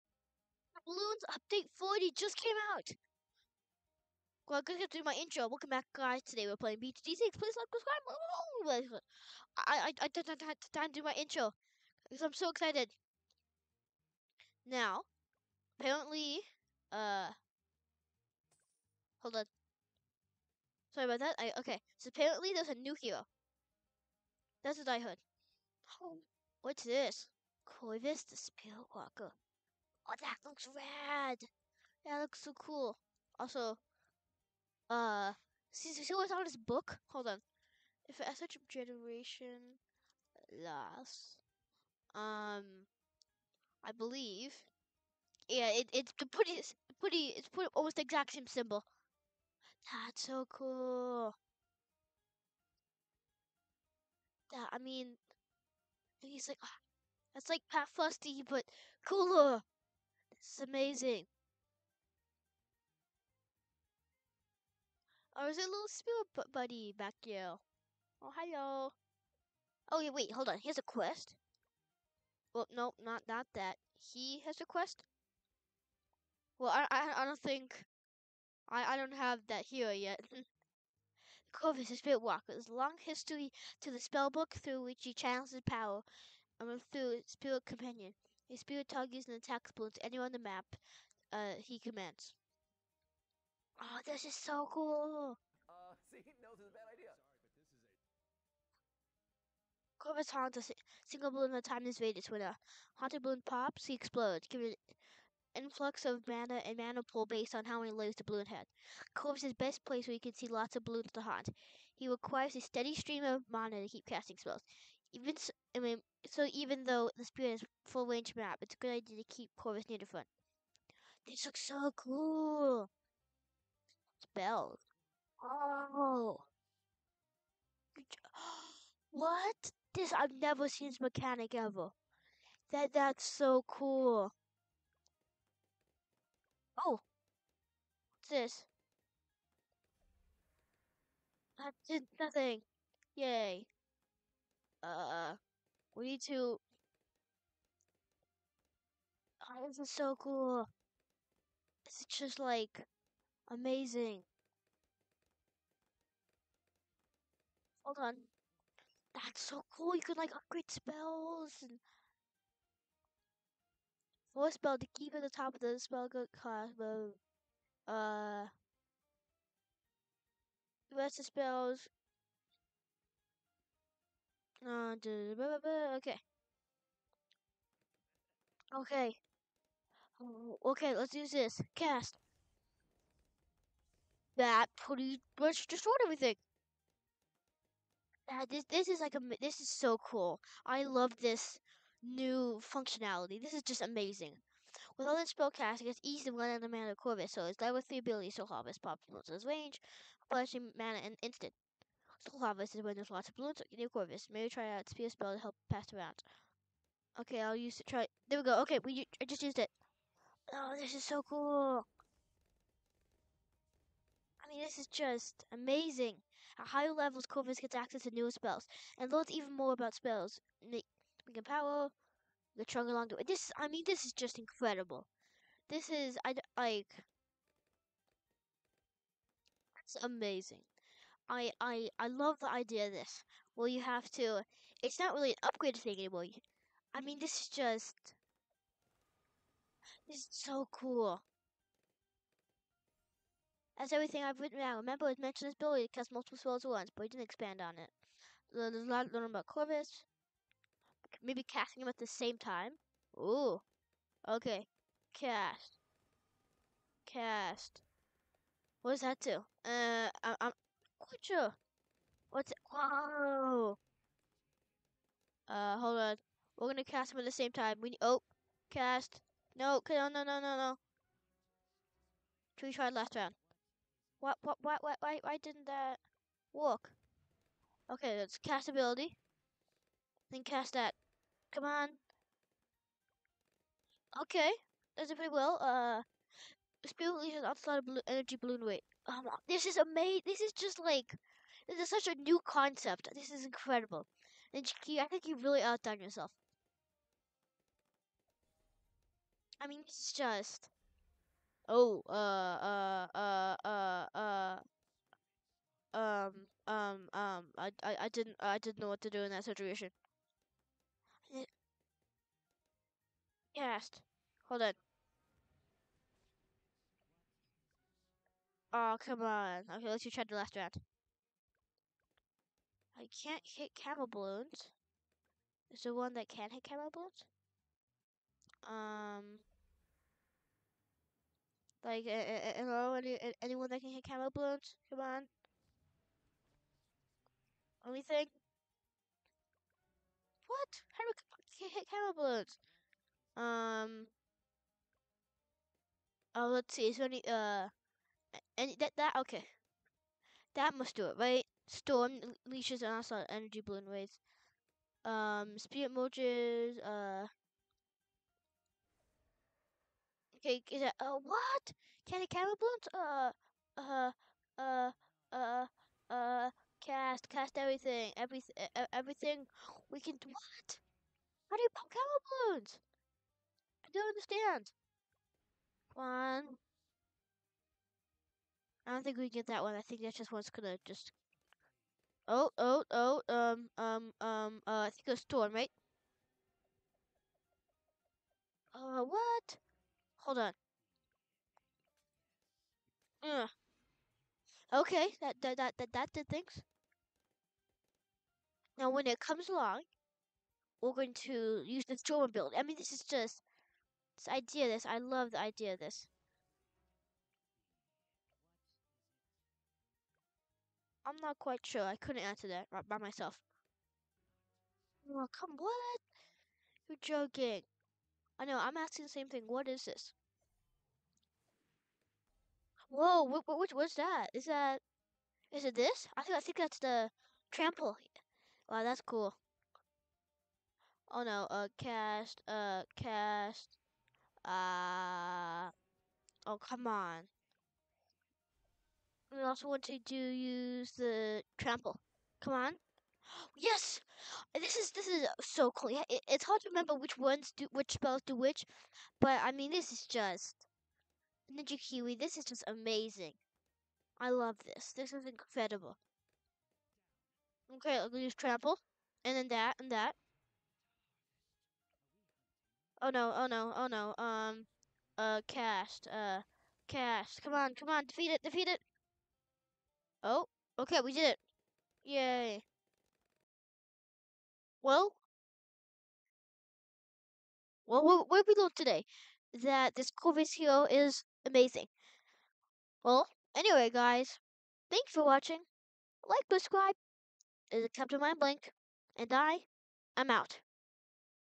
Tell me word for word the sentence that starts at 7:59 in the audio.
That this Corvus hero is amazing.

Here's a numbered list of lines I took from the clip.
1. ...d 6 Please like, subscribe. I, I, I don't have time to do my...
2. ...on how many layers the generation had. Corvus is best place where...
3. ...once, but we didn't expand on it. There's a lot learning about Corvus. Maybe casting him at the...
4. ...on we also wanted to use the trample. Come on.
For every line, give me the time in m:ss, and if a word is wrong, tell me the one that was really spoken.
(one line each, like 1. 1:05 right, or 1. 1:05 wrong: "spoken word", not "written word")
1. 0:06 right
2. 1:47 wrong: "balloon", not "generation"
3. 4:06 right
4. 7:16 right.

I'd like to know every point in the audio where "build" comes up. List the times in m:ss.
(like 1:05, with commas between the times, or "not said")
6:42.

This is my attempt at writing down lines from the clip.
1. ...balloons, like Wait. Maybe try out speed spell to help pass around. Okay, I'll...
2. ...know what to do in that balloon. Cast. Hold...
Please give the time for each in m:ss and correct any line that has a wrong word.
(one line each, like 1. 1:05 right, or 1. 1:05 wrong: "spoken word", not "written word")
1. 3:23 wrong: "Corvus", not "Wait"
2. 5:08 wrong: "situation", not "balloon".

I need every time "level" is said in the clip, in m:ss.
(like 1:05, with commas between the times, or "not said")
3:17, 3:36.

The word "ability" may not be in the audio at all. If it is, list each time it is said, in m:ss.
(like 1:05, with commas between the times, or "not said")
3:17, 4:05, 4:38.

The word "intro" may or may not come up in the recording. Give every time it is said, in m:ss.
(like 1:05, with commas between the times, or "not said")
0:05, 0:11.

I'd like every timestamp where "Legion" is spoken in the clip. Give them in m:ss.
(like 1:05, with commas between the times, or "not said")
4:47.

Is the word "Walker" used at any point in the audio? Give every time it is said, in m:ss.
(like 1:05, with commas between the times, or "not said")
0:28, 1:22.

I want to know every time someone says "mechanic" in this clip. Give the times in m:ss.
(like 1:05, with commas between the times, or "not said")
2:11.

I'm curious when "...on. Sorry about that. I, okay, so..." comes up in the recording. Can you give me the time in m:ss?
0:19.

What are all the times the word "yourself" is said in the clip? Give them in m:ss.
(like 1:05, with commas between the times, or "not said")
4:56.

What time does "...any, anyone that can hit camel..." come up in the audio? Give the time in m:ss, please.
5:32.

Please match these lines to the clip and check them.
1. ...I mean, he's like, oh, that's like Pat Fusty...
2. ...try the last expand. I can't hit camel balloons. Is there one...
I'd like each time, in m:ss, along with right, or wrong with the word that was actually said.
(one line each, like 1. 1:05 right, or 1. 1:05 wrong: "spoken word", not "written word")
1. 0:54 right
2. 5:20 wrong: "round", not "expand".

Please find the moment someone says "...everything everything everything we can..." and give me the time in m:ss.
6:07.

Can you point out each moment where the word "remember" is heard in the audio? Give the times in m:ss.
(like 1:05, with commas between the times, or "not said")
4:04, 7:26.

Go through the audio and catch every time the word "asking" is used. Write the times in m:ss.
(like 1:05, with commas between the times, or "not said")
6:58.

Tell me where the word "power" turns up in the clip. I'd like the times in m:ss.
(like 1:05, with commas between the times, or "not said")
1:25, 3:41.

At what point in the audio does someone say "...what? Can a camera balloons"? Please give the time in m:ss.
6:01.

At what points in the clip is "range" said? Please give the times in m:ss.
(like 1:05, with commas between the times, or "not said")
1:58, 3:19.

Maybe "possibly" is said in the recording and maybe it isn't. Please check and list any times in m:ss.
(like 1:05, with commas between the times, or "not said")
not said.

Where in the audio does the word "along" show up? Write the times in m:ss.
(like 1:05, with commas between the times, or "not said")
3:42, 6:39.